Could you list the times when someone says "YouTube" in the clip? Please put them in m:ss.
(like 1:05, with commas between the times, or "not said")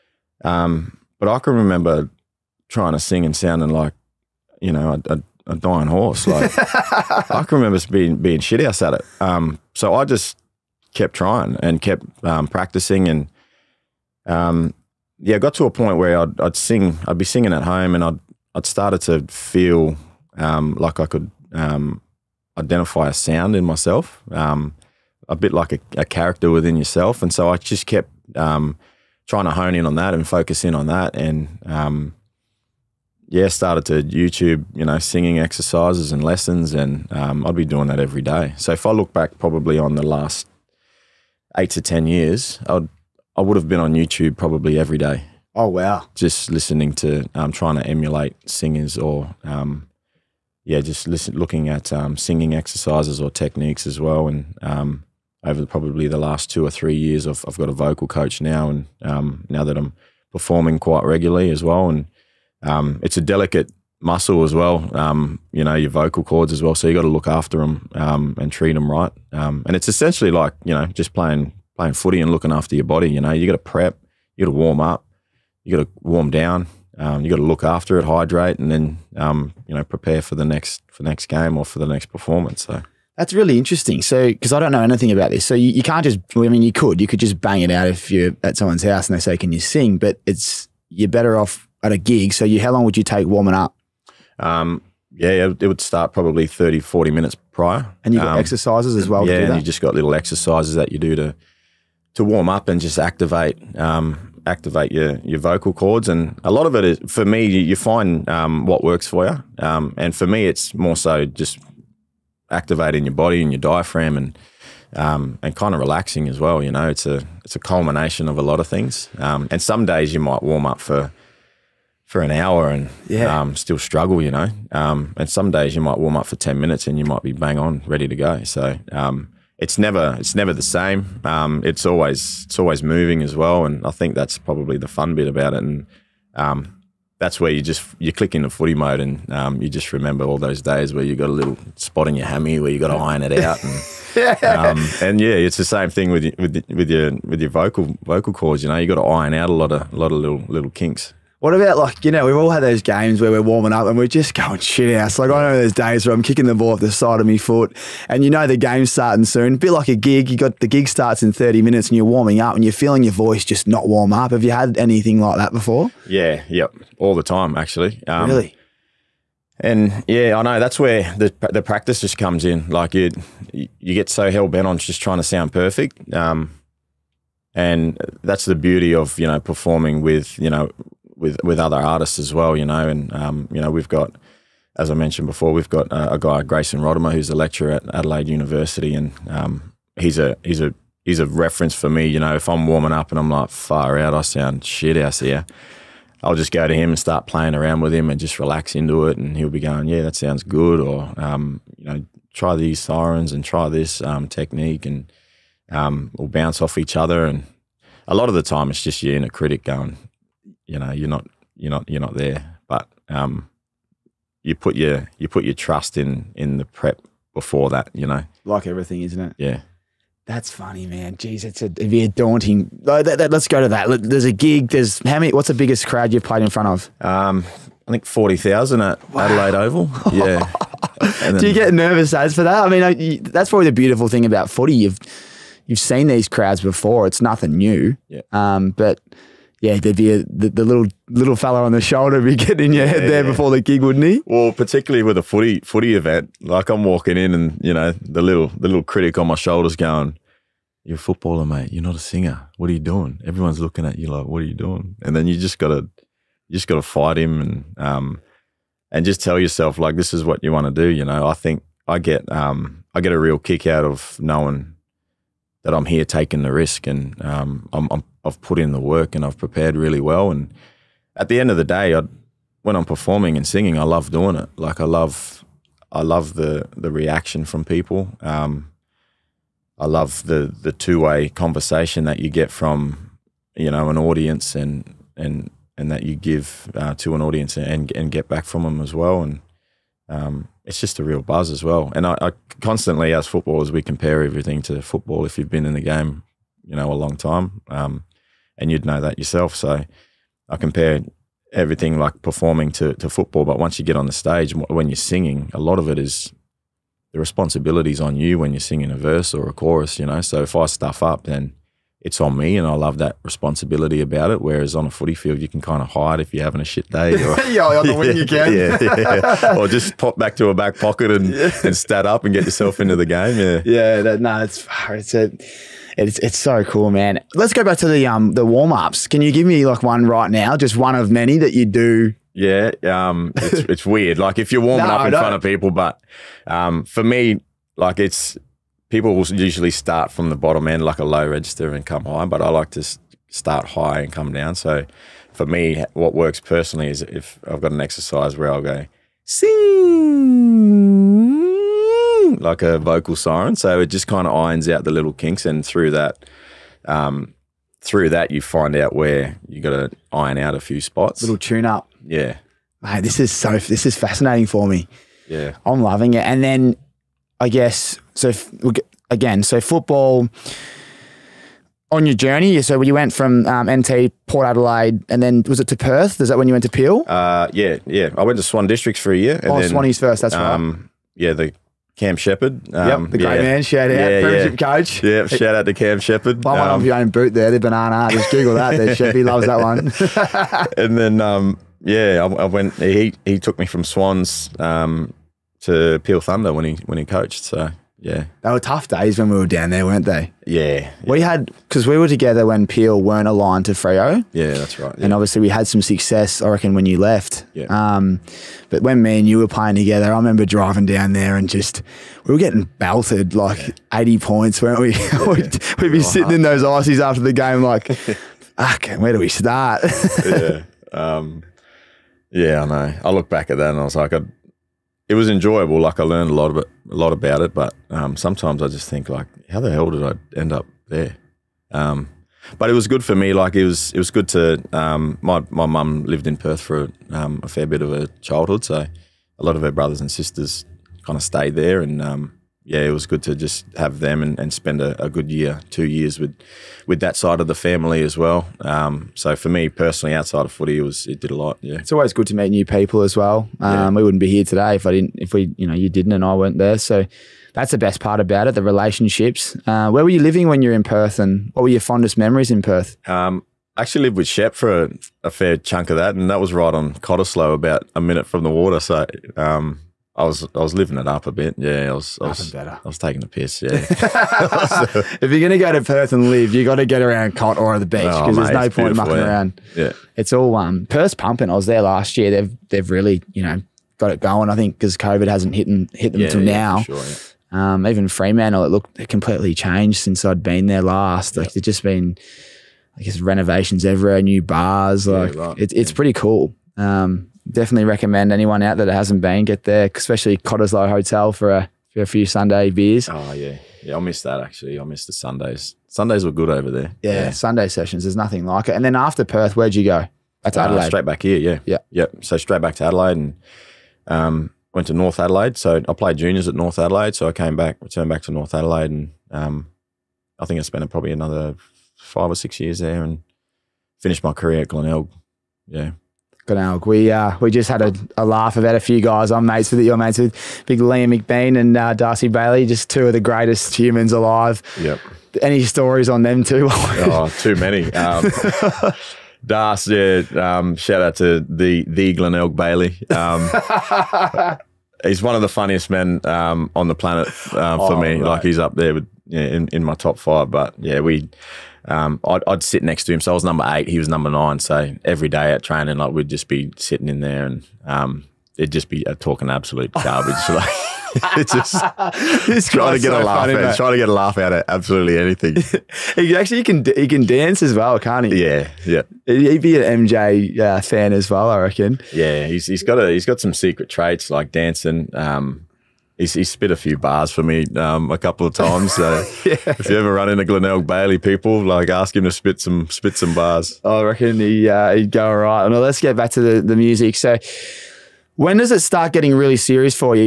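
0:34, 0:43.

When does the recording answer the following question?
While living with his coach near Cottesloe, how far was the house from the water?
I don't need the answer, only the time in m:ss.
7:47.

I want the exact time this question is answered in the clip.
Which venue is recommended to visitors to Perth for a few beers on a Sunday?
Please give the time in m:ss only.
8:20.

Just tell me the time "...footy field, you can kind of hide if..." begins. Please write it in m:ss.
5:14.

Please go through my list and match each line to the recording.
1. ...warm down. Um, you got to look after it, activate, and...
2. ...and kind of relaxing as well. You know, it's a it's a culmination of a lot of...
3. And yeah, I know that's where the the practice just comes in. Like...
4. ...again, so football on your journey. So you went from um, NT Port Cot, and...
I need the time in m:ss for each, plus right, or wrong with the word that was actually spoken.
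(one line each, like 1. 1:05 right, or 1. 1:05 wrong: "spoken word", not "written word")
1. 1:16 wrong: "hydrate", not "activate"
2. 1:55 right
3. 2:49 right
4. 6:09 wrong: "Adelaide", not "Cot".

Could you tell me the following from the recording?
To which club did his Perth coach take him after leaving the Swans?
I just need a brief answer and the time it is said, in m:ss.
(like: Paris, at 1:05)
Peel Thunder, at 6:36.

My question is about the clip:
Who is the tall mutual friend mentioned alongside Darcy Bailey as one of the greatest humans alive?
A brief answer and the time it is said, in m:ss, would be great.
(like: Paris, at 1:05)
Liam McBean, at 8:50.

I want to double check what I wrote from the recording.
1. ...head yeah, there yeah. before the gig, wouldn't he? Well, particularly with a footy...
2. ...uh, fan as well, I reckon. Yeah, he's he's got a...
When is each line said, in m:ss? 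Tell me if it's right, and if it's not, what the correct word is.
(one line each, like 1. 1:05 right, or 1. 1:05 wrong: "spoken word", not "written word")
1. 4:02 right
2. 9:30 right.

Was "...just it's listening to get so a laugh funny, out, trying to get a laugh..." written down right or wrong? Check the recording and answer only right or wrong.
wrong.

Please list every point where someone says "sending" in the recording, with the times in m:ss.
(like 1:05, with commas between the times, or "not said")
not said.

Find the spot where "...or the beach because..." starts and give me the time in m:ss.
7:57.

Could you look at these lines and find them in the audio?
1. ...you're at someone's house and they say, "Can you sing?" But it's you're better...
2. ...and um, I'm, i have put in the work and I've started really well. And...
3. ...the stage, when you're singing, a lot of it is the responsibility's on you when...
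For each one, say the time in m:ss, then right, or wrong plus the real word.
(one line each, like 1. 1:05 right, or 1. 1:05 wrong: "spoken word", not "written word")
1. 1:28 right
2. 4:26 wrong: "prepared", not "started"
3. 5:04 right.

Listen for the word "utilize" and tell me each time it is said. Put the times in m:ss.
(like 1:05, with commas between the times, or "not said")
not said.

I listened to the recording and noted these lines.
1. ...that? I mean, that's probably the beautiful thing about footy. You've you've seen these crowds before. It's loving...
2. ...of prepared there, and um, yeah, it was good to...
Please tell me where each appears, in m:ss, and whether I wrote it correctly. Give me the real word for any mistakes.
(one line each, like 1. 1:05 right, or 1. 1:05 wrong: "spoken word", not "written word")
1. 3:52 wrong: "nothing", not "loving"
2. 7:21 wrong: "stayed", not "prepared".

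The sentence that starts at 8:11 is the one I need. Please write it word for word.
Like there's just been, I guess, renovations everywhere, new bars.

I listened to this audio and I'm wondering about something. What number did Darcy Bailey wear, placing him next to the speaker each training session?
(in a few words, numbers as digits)
9.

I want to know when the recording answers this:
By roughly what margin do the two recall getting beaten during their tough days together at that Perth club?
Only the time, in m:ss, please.
6:53.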